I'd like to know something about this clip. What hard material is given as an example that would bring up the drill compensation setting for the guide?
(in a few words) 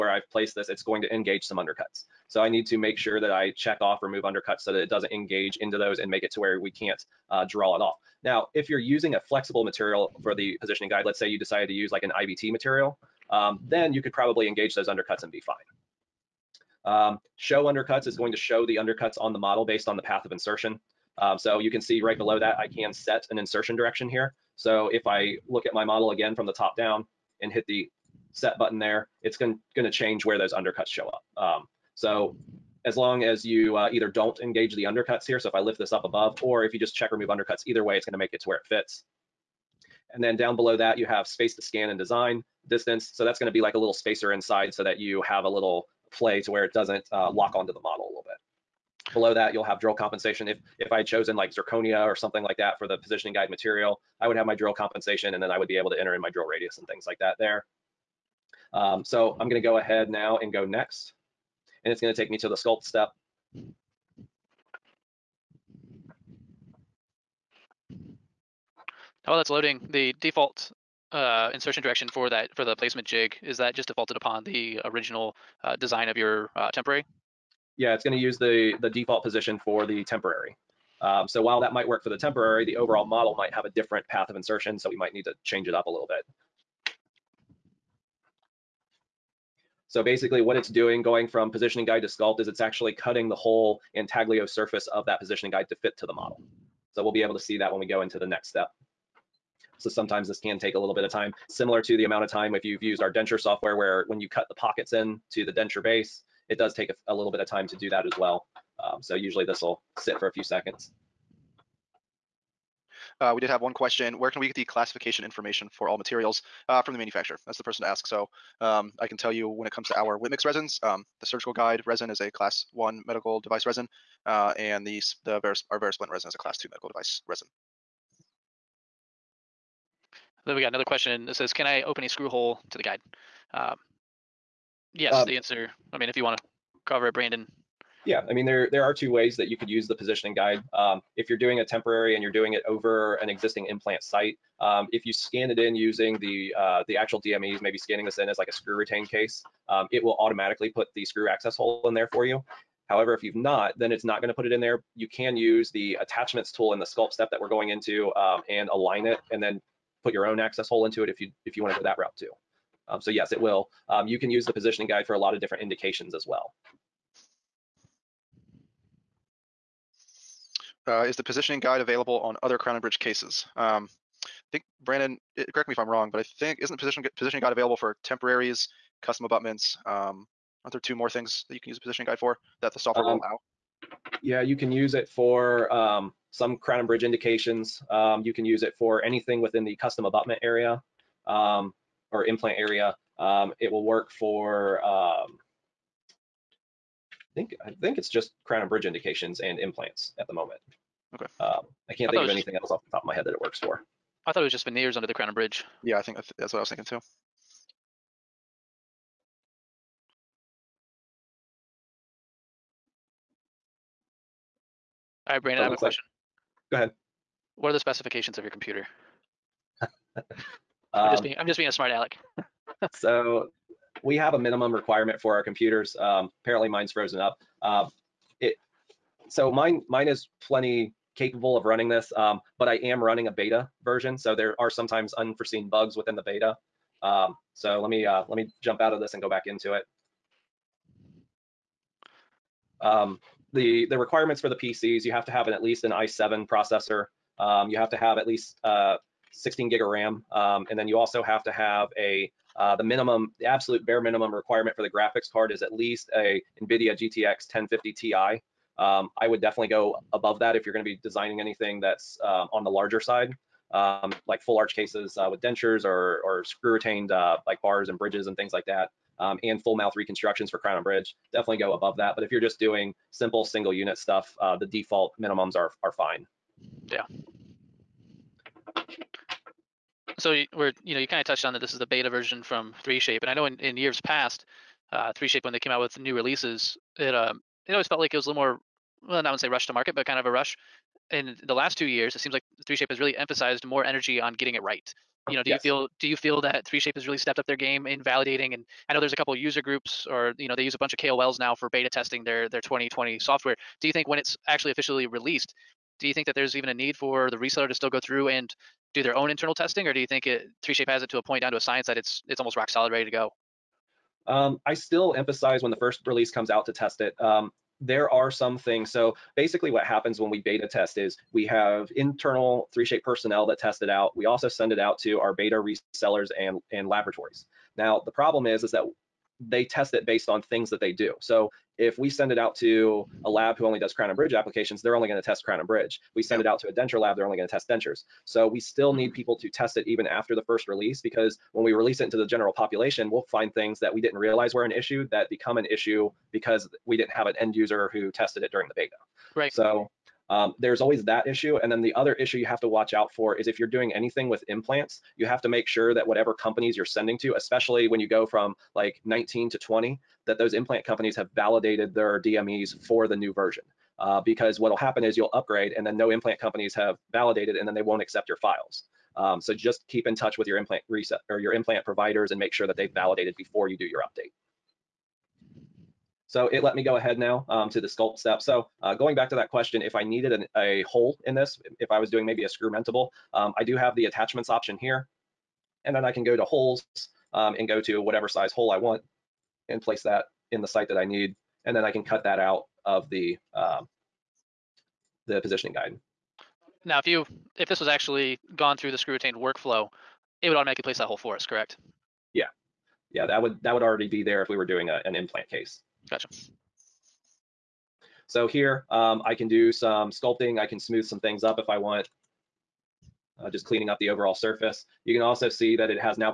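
zirconia.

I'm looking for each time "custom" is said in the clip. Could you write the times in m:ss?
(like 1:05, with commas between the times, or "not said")
2:59, 3:09.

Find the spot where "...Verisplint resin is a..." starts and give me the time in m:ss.
2:05.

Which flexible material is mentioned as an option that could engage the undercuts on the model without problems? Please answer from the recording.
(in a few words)
IVT.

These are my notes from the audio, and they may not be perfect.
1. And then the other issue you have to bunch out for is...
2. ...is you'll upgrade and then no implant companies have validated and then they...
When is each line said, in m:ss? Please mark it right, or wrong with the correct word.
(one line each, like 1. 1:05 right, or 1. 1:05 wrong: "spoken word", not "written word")
1. 5:51 wrong: "watch", not "bunch"
2. 6:05 right.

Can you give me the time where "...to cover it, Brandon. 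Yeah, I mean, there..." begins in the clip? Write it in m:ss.
2:16.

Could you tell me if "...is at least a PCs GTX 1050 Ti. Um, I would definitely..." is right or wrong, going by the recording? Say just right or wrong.
wrong.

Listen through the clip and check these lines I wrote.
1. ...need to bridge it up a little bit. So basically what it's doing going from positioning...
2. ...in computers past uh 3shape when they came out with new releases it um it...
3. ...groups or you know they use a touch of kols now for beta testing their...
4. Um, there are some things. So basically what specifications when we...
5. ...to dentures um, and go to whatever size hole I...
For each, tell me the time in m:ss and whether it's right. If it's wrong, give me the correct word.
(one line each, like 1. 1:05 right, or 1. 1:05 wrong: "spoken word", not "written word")
1. 1:25 wrong: "change", not "bridge"
2. 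4:43 wrong: "years", not "computers"
3. 4:59 wrong: "bunch", not "touch"
4. 5:17 wrong: "happens", not "specifications"
5. 6:26 wrong: "holes", not "dentures".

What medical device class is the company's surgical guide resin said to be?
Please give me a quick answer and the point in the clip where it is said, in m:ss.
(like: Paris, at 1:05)
class 1, at 2:02.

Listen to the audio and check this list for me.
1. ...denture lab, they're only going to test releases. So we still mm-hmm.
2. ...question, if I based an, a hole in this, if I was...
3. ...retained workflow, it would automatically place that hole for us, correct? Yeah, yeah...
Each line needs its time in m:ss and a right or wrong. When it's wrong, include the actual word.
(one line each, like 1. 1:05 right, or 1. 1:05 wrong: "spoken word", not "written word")
1. 5:36 wrong: "dentures", not "releases"
2. 6:19 wrong: "needed", not "based"
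3. 6:39 right.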